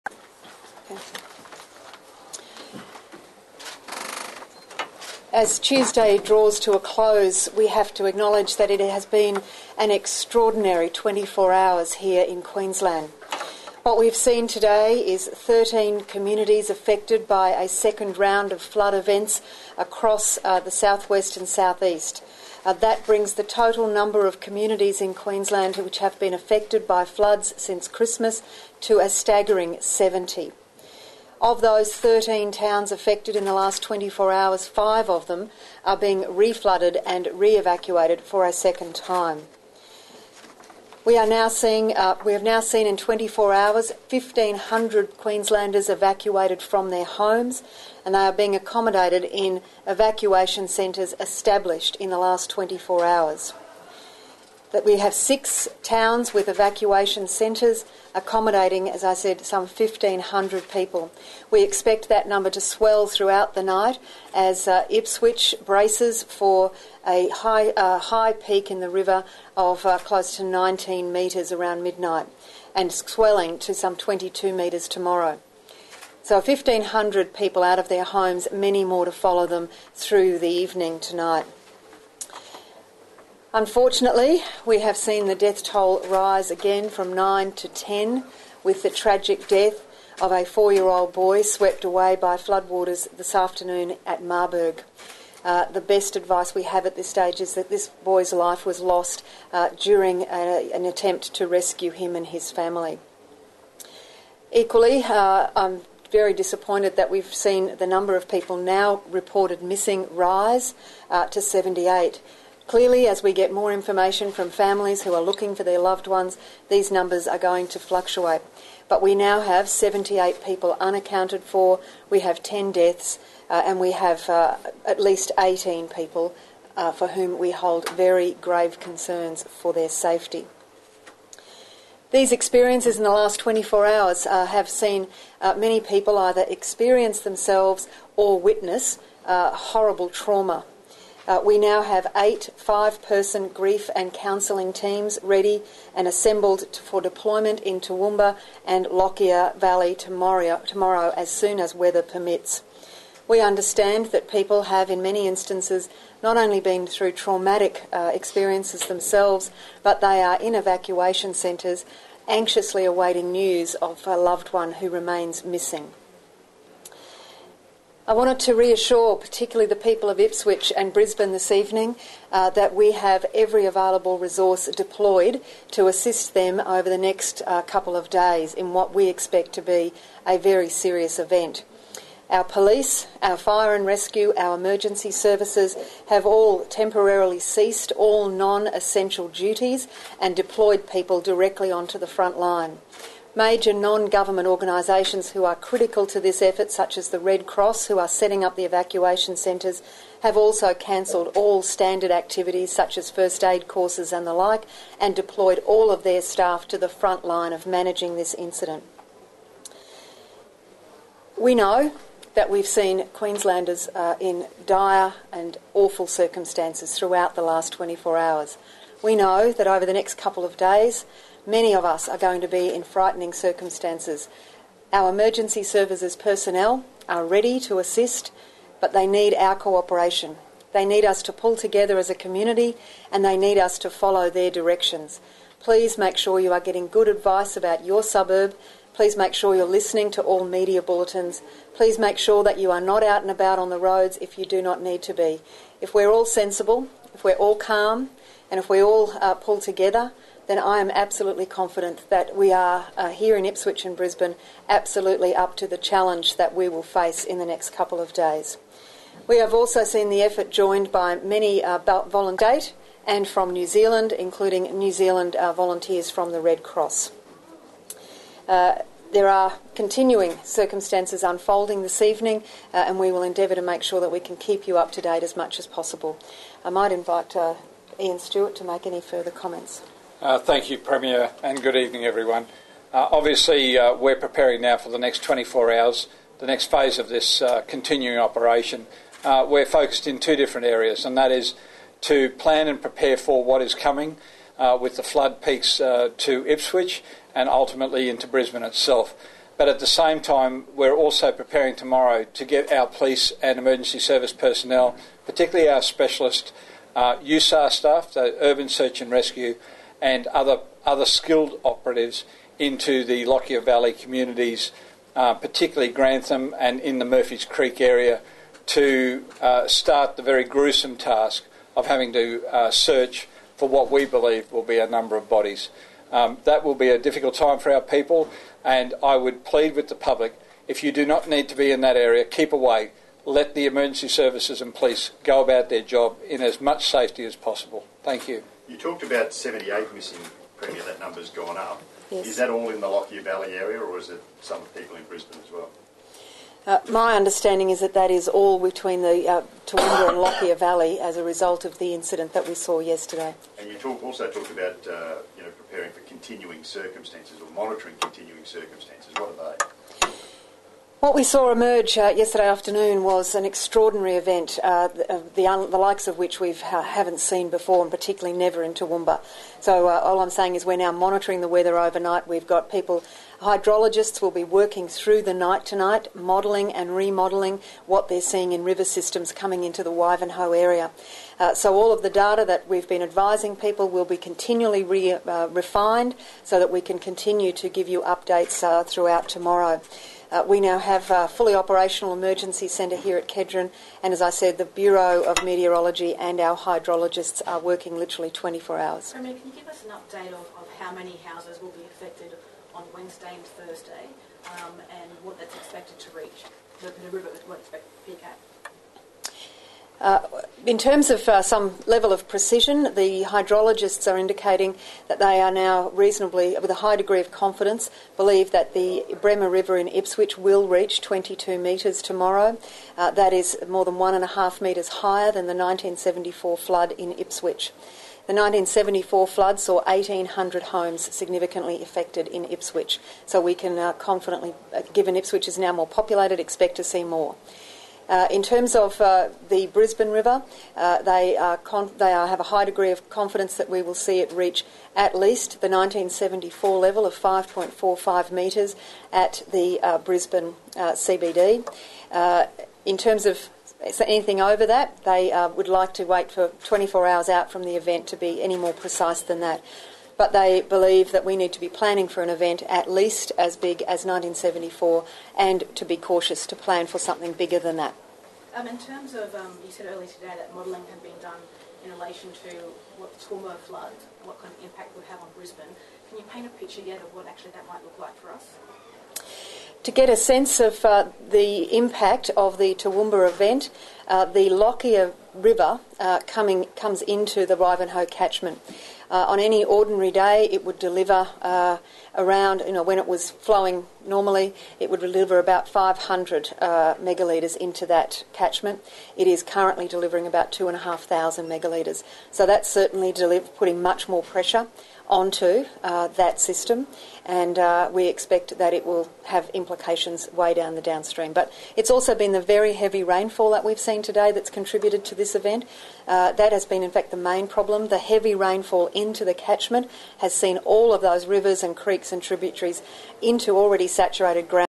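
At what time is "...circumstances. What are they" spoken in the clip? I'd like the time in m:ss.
5:58.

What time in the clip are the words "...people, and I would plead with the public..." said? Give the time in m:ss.
5:27.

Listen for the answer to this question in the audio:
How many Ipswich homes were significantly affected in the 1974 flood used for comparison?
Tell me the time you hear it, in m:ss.
7:09.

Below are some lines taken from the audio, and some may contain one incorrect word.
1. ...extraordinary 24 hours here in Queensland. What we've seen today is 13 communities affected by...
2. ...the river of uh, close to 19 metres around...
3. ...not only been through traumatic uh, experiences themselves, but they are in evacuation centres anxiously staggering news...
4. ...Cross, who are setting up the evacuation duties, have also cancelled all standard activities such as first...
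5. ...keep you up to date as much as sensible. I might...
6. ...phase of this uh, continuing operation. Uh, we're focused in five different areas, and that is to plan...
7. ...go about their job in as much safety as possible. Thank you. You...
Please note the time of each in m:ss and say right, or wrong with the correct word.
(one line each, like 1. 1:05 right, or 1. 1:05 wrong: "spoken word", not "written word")
1. 0:09 right
2. 1:08 right
3. 2:36 wrong: "awaiting", not "staggering"
4. 3:17 wrong: "centres", not "duties"
5. 4:34 wrong: "possible", not "sensible"
6. 4:46 wrong: "two", not "five"
7. 5:35 right.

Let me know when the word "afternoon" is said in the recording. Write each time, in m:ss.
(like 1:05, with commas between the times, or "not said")
1:33, 6:02.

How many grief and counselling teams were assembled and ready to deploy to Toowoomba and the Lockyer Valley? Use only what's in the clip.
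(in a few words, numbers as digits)
8.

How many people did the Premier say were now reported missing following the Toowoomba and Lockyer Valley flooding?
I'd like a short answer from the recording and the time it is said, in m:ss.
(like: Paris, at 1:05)
78, at 1:50.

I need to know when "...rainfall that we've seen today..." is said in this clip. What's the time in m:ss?
8:33.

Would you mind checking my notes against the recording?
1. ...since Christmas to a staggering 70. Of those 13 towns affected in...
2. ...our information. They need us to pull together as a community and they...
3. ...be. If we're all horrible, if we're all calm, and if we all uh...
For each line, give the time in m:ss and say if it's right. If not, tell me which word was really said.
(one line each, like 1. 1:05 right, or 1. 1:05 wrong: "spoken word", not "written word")
1. 0:27 right
2. 3:49 wrong: "cooperation", not "information"
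3. 4:05 wrong: "sensible", not "horrible".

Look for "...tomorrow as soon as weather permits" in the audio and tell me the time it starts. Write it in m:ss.
2:30.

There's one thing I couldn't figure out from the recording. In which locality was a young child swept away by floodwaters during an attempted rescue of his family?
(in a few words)
Marburg.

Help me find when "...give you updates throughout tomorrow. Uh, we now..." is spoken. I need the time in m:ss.
6:27.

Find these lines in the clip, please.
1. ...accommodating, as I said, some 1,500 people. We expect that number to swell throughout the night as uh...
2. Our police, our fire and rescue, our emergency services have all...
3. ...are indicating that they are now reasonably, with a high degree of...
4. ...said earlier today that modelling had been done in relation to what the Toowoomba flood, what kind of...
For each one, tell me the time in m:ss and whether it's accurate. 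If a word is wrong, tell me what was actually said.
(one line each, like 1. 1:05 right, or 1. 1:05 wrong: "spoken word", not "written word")
1. 0:58 right
2. 3:02 right
3. 6:54 right
4. 7:49 right.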